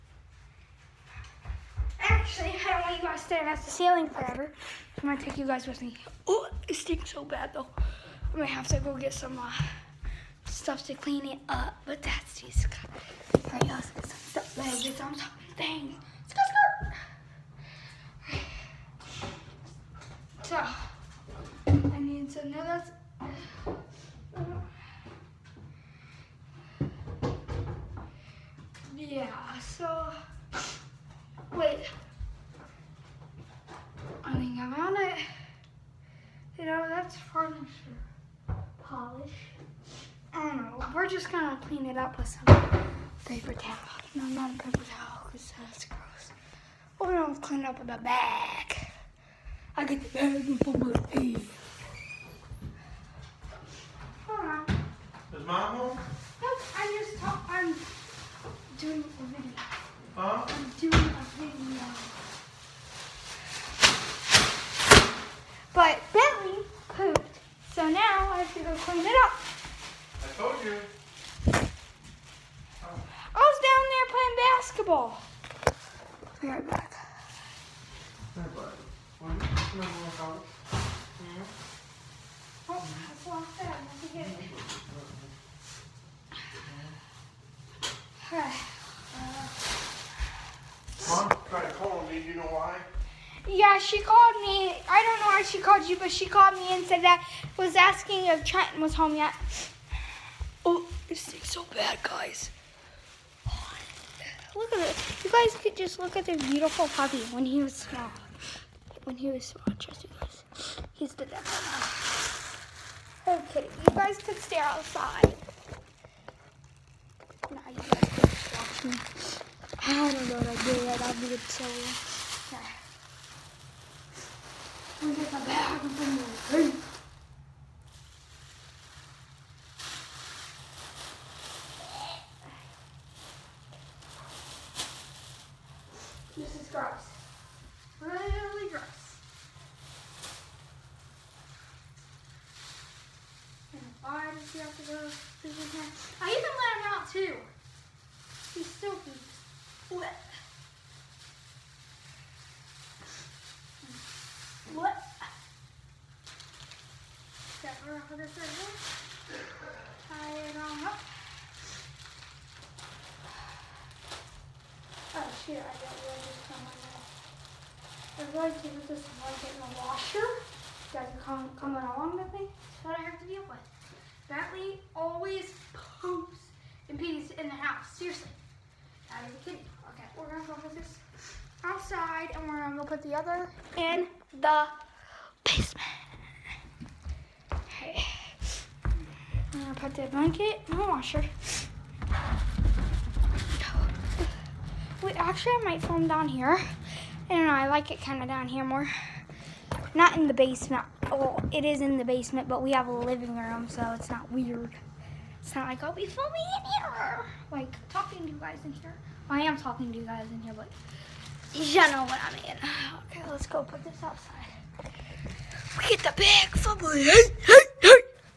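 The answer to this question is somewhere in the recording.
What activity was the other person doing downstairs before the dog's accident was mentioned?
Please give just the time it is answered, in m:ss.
1:14.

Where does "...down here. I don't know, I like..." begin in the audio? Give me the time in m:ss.
3:16.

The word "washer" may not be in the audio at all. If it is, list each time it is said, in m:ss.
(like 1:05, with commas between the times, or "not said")
2:49, 3:10.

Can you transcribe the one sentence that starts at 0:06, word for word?
Oh, it stinks so bad though.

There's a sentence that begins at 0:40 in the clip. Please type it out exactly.
We're just gonna clean it up with some paper towel.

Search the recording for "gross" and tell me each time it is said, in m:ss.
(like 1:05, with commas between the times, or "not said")
0:45.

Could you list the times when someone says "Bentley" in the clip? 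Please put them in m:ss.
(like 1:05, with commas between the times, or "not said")
1:06, 2:54.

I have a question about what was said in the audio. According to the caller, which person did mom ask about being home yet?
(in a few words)
Trenton.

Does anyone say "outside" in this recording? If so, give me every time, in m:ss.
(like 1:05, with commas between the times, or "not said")
1:54, 3:01, 3:34.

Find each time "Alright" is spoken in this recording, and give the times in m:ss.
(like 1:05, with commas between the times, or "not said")
0:13, 1:28.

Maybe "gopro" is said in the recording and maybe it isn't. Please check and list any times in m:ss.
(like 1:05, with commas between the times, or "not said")
not said.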